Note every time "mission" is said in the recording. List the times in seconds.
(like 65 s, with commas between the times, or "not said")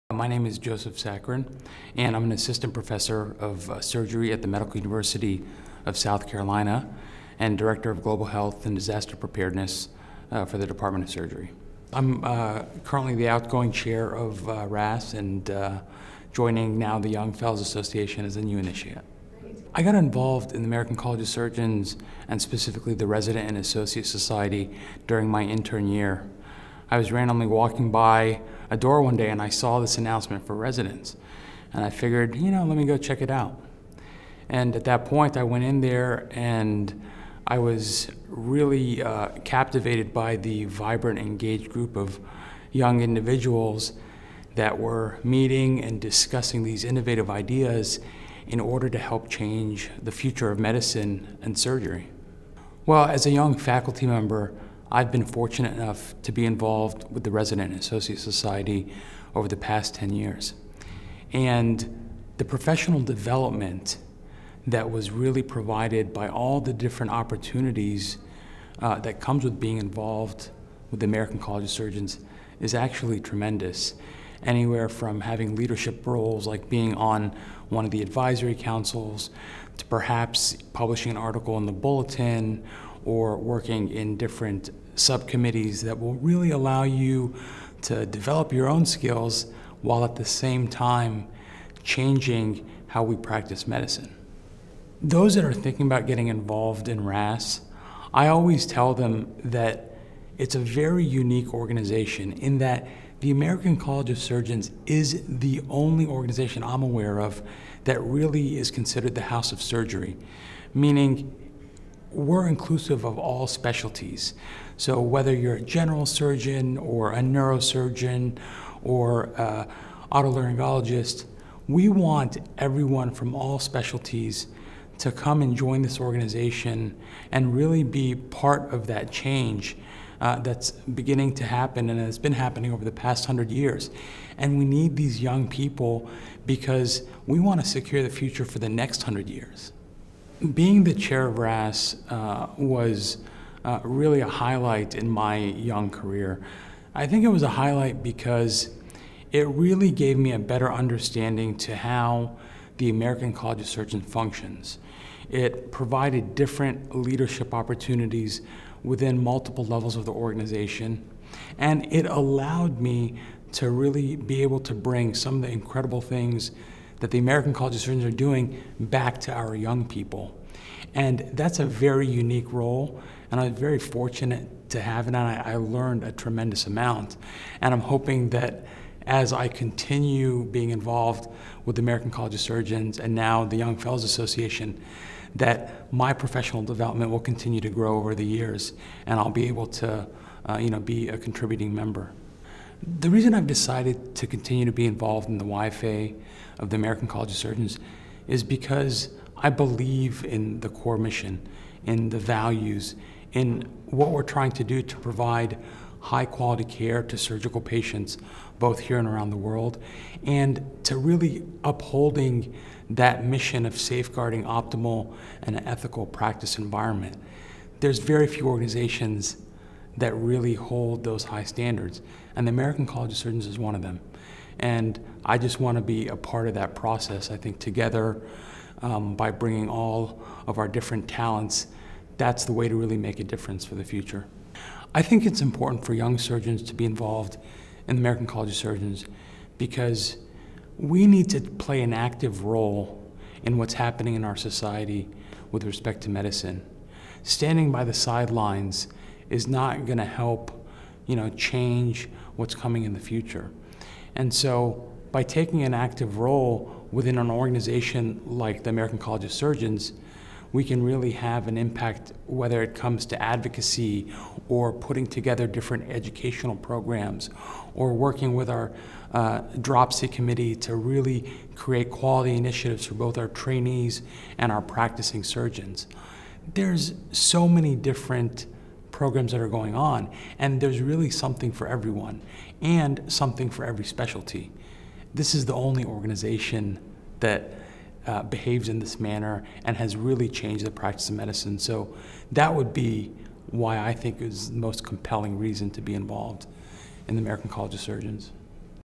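200 s, 213 s.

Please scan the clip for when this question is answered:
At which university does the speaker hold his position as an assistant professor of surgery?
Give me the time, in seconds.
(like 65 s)
4 s.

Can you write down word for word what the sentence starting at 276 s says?
There's so many different programs that are going on.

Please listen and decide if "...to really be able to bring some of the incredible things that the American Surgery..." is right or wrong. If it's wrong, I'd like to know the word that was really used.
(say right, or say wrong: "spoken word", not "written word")
wrong: "College", not "Surgery".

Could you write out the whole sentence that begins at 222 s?
And the American College of Surgeons is one of them.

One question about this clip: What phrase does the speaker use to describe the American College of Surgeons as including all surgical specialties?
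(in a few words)
the house of surgery.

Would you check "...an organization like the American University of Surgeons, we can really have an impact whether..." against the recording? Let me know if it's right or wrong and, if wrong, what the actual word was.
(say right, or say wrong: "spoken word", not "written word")
wrong: "College", not "University".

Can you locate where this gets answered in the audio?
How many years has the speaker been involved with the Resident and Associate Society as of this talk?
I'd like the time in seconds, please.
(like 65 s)
59 s.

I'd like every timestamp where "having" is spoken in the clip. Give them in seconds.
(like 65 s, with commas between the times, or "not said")
75 s.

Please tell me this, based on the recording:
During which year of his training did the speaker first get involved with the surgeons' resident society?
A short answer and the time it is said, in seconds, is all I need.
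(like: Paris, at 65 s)
intern year, at 25 s.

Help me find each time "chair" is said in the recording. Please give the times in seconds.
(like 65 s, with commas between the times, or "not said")
13 s, 140 s.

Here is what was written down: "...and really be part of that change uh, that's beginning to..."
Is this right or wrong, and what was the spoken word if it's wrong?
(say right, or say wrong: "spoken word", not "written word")
right.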